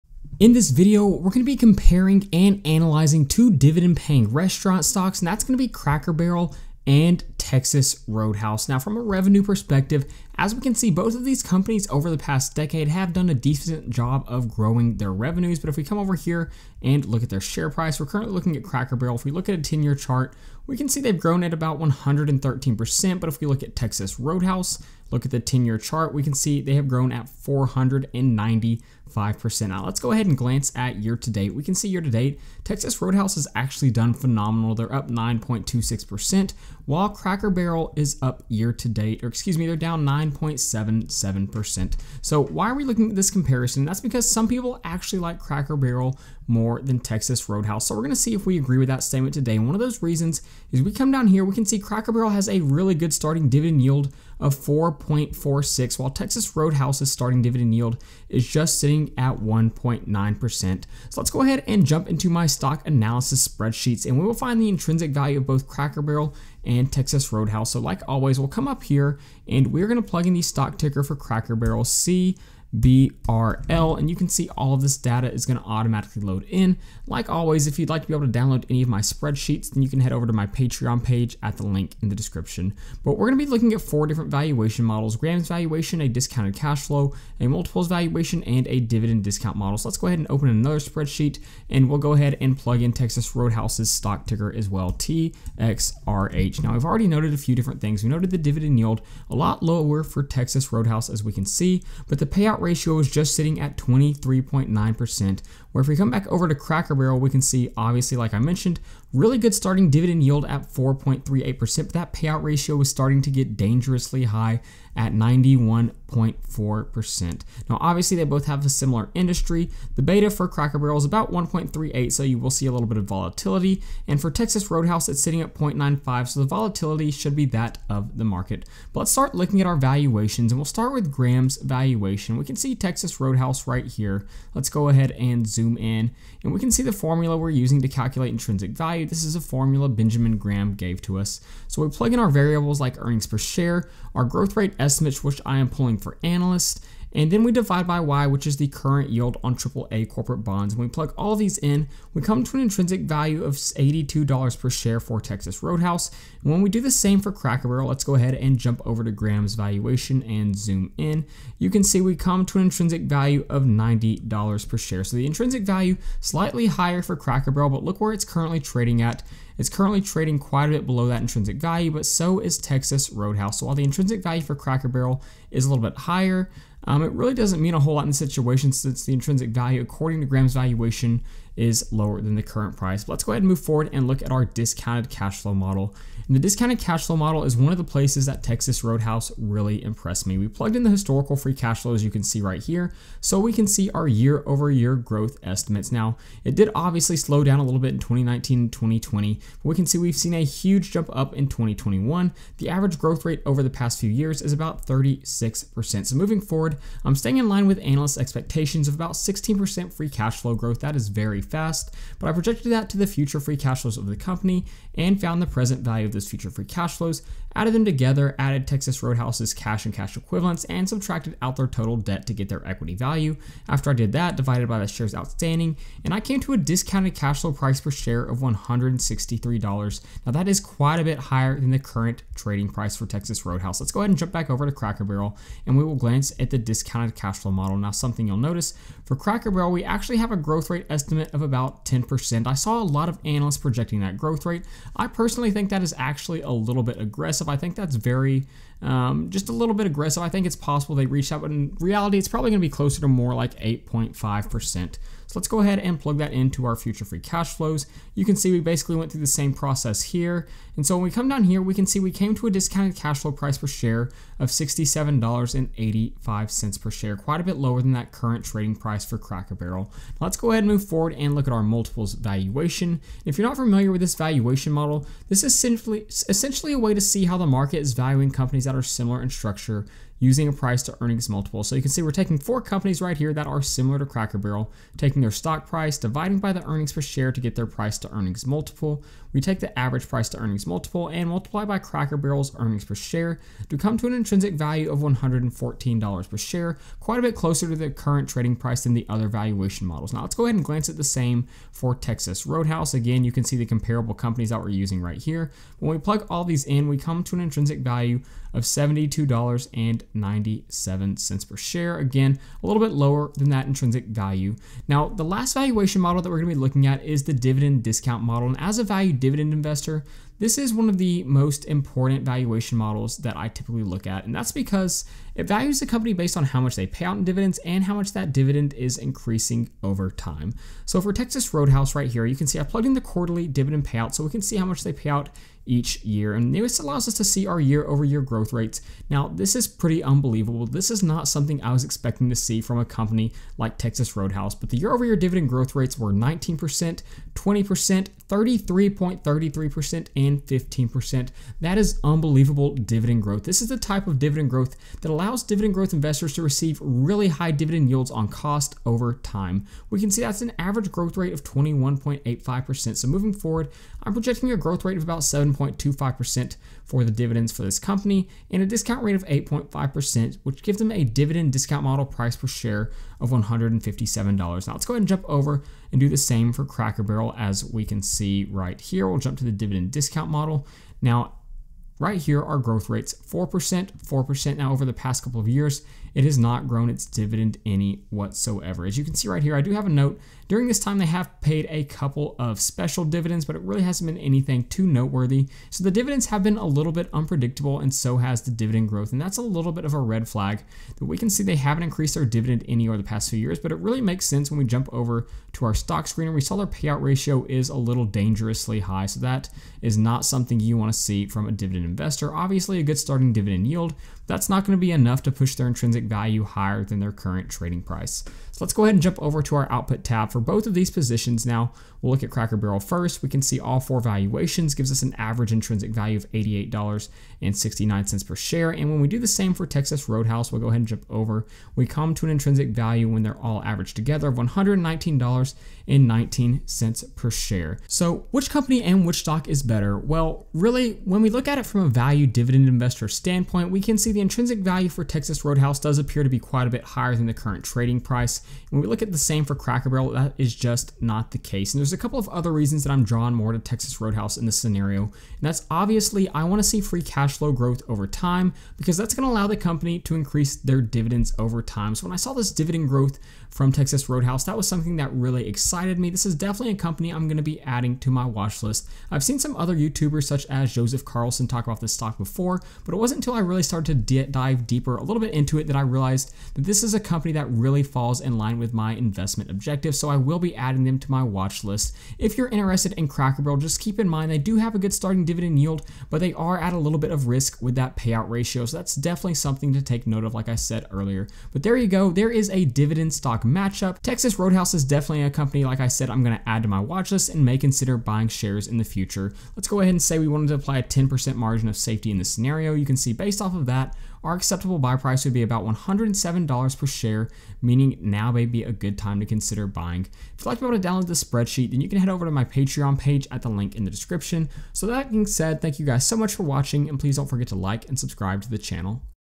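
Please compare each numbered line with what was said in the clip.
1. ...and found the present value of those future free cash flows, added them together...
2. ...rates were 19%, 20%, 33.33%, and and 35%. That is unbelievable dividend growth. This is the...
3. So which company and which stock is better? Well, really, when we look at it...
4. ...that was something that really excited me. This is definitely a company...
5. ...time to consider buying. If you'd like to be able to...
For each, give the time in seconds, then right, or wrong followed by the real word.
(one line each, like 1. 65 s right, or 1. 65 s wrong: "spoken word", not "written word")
1. 214 s right
2. 345 s wrong: "15", not "35"
3. 437 s right
4. 464 s right
5. 508 s right.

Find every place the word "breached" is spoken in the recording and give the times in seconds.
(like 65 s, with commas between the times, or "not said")
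not said.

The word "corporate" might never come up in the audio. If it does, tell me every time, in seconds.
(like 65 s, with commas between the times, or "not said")
150 s.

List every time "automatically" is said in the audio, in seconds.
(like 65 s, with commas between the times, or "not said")
75 s.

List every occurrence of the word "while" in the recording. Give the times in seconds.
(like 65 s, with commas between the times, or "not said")
36 s, 55 s, 173 s.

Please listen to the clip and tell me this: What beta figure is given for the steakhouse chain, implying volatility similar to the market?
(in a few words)
0.95.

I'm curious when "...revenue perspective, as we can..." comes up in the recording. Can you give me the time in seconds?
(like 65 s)
9 s.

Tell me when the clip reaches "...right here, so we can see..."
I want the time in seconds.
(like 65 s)
192 s.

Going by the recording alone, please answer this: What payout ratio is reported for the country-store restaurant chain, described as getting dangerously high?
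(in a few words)
91.4%.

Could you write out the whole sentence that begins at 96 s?
Now we've already noted a few different things.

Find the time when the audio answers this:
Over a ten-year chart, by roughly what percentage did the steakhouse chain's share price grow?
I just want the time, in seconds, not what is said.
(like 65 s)
27 s.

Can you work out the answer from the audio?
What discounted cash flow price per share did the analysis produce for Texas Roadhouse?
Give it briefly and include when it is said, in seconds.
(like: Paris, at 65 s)
$163, at 228 s.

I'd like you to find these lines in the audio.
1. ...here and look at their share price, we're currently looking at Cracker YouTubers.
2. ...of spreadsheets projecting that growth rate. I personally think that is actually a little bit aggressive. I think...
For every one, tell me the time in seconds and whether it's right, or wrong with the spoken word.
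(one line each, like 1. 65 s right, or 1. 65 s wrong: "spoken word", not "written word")
1. 16 s wrong: "Barrel", not "YouTubers"
2. 243 s wrong: "analysts", not "spreadsheets".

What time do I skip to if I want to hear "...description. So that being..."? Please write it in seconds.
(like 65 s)
513 s.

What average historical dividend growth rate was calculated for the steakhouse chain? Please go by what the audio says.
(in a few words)
21.85%.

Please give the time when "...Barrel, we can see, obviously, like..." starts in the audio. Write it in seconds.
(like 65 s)
106 s.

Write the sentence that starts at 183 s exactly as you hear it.
But let's go ahead and move forward and look at our discounted cash flow model.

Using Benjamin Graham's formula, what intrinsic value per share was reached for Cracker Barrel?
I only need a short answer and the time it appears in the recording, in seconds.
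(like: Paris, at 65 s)
$90, at 163 s.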